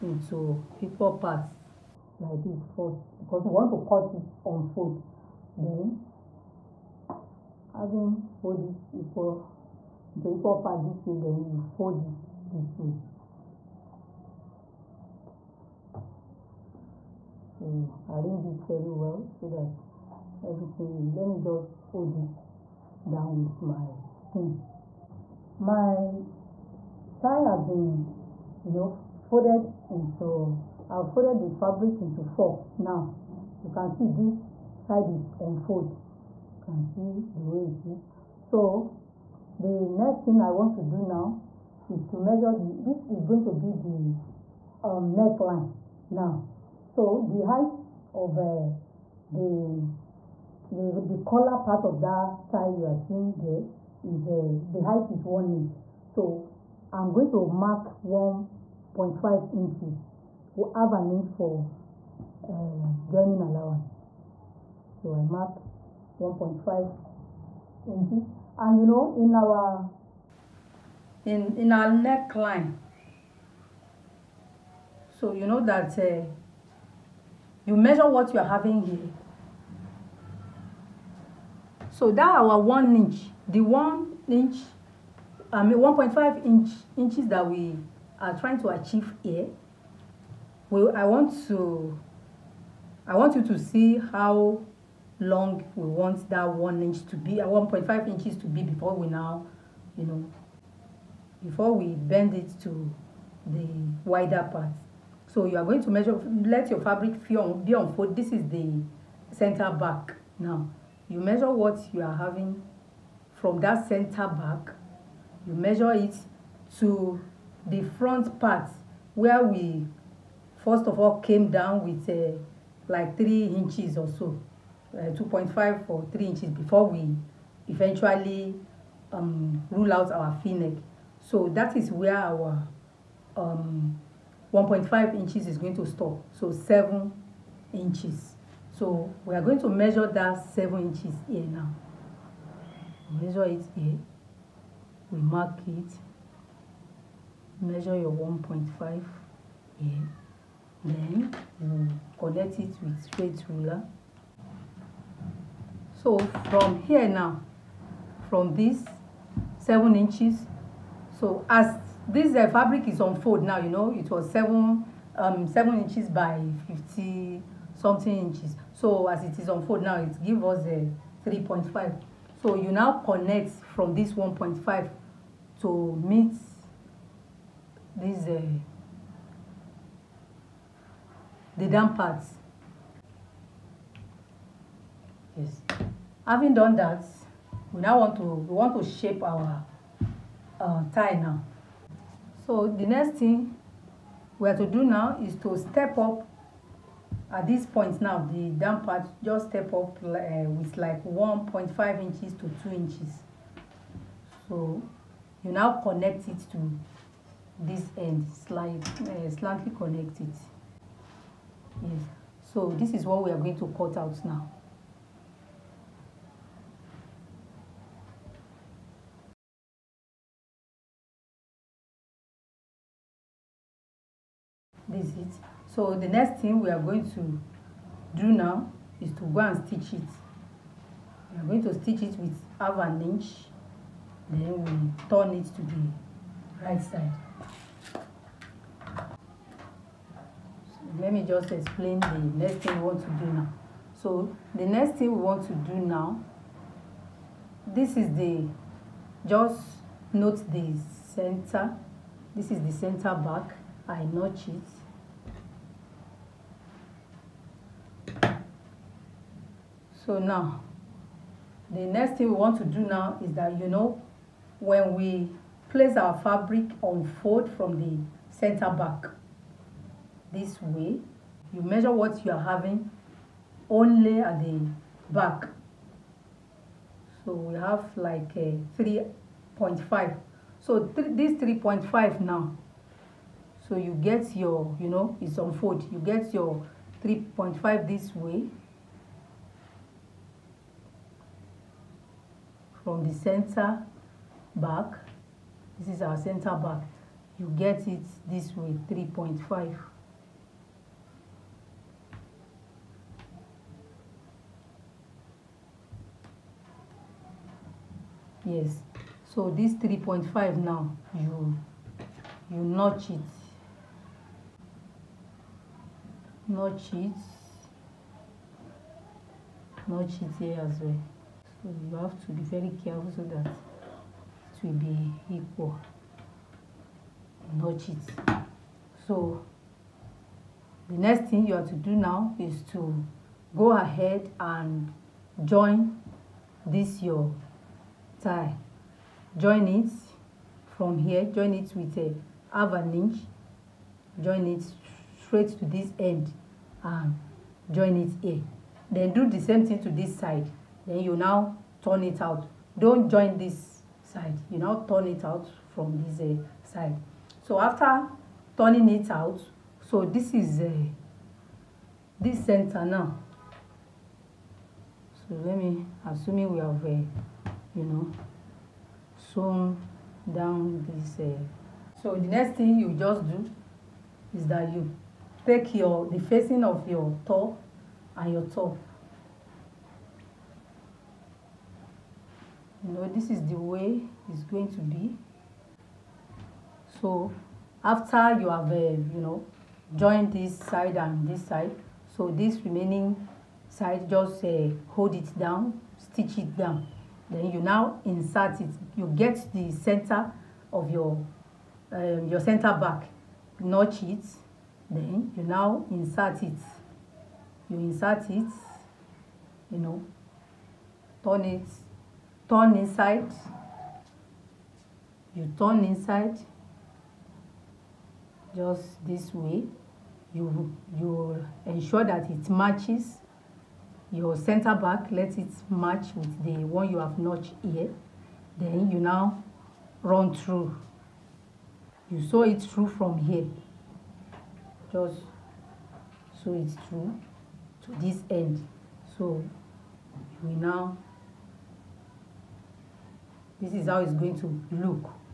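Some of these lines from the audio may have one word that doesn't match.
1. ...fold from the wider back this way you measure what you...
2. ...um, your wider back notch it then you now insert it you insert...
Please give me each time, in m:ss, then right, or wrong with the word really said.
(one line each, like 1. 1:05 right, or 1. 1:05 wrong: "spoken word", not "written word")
1. 4:27 wrong: "center", not "wider"
2. 6:41 wrong: "center", not "wider".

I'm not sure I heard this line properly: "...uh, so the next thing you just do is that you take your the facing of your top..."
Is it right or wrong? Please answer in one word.
right.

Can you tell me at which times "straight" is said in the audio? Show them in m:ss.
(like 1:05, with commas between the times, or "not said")
2:33, 5:45.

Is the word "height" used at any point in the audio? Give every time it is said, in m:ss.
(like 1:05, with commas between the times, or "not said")
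0:47, 0:54.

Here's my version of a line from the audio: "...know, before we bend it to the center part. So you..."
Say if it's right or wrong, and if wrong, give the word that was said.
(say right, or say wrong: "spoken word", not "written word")
wrong: "wider", not "center".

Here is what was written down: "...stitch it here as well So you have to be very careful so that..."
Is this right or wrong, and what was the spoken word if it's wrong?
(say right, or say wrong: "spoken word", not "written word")
wrong: "notch", not "stitch".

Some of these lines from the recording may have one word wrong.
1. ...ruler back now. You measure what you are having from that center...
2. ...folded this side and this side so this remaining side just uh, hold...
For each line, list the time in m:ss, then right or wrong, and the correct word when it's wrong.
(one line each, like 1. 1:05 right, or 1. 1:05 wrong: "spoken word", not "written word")
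1. 1:49 wrong: "center", not "ruler"
2. 6:29 wrong: "joined", not "folded".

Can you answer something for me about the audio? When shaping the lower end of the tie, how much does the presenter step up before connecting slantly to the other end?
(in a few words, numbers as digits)
1.5 to 2 inches.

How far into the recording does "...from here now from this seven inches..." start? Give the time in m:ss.
2:36.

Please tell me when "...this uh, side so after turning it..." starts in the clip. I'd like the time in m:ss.
5:56.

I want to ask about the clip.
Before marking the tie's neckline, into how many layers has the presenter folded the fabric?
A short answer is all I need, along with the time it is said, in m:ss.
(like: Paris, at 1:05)
4, at 0:32.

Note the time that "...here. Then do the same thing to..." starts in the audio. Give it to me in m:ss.
5:48.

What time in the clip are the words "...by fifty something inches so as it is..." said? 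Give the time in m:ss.
2:46.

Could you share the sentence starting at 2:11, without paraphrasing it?
So that is where our um, 1.5 inches is going to stop.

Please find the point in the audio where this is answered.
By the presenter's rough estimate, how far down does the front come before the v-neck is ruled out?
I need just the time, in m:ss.
2:04.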